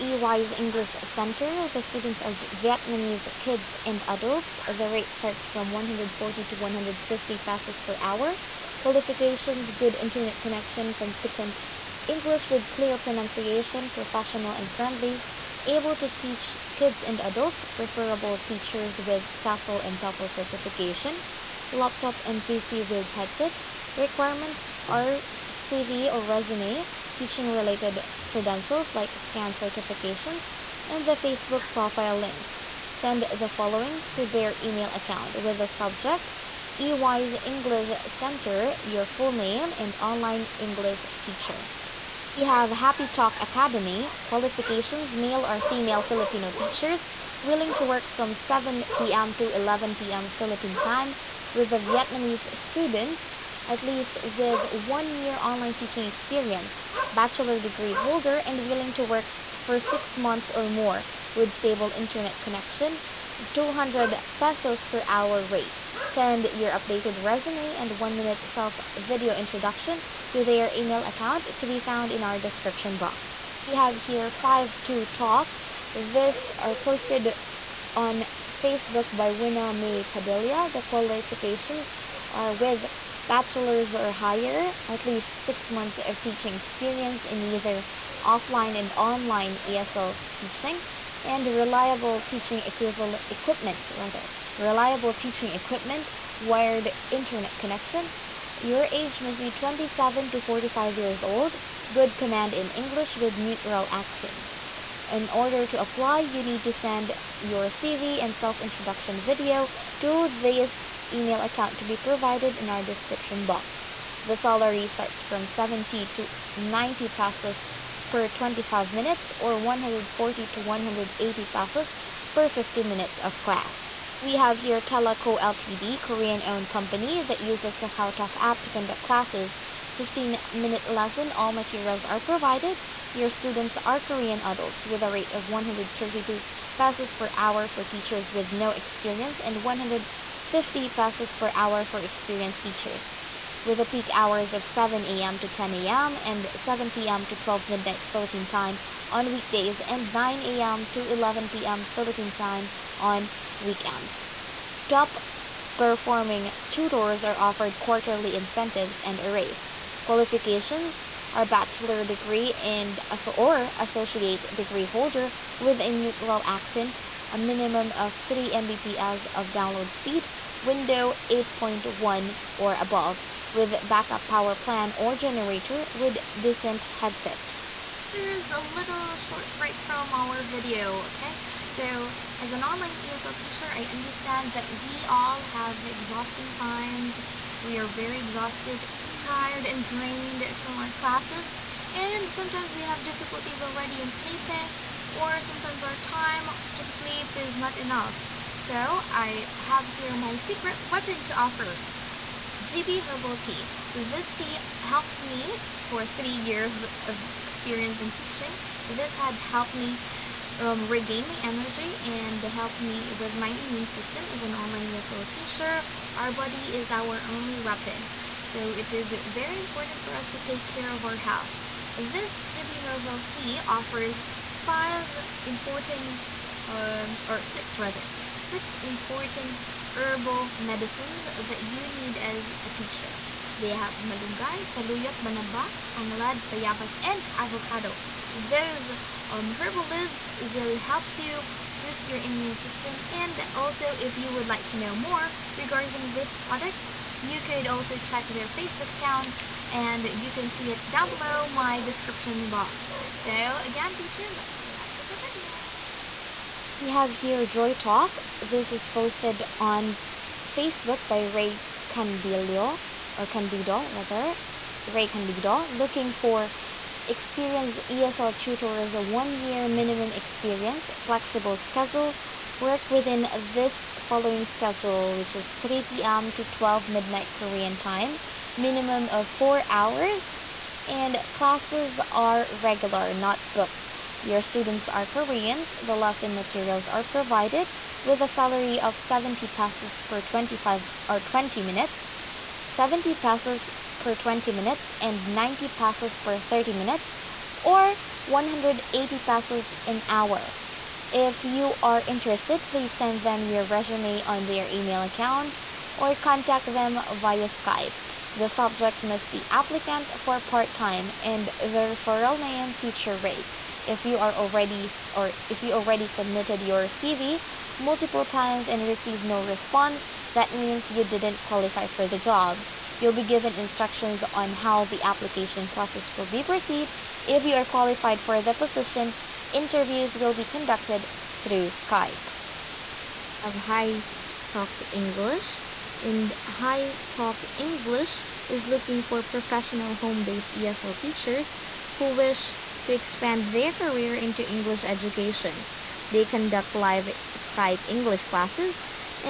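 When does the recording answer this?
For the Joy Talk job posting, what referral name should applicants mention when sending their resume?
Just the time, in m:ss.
5:12.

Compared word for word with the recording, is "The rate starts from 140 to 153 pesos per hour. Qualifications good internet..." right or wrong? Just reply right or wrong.
wrong.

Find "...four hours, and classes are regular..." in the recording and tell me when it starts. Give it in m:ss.
4:39.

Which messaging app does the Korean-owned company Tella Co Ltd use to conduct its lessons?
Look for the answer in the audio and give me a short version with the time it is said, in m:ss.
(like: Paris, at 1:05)
KakaoTalk, at 2:07.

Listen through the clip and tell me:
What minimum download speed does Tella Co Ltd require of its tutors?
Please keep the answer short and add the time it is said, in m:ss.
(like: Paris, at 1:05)
3 Mbps, at 2:48.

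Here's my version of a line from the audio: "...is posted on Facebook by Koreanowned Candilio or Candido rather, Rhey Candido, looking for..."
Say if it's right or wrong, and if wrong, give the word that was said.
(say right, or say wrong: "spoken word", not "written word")
wrong: "Rhey", not "Koreanowned".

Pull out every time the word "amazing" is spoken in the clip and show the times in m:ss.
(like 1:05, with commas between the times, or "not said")
not said.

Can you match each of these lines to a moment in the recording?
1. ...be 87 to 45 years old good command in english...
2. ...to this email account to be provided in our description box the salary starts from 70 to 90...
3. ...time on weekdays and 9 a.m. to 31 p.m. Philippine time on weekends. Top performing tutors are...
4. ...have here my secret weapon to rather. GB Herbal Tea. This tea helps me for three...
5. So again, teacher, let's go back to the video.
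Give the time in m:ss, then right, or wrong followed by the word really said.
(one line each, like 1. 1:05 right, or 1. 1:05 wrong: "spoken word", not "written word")
1. 1:39 wrong: "27", not "87"
2. 1:49 right
3. 2:28 wrong: "11", not "31"
4. 3:19 wrong: "offer", not "rather"
5. 4:13 right.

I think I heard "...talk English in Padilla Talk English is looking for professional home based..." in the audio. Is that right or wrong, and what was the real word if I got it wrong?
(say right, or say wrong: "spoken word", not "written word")
wrong: "High", not "Padilla".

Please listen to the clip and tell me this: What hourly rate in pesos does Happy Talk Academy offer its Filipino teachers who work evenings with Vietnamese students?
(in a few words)
200 pesos.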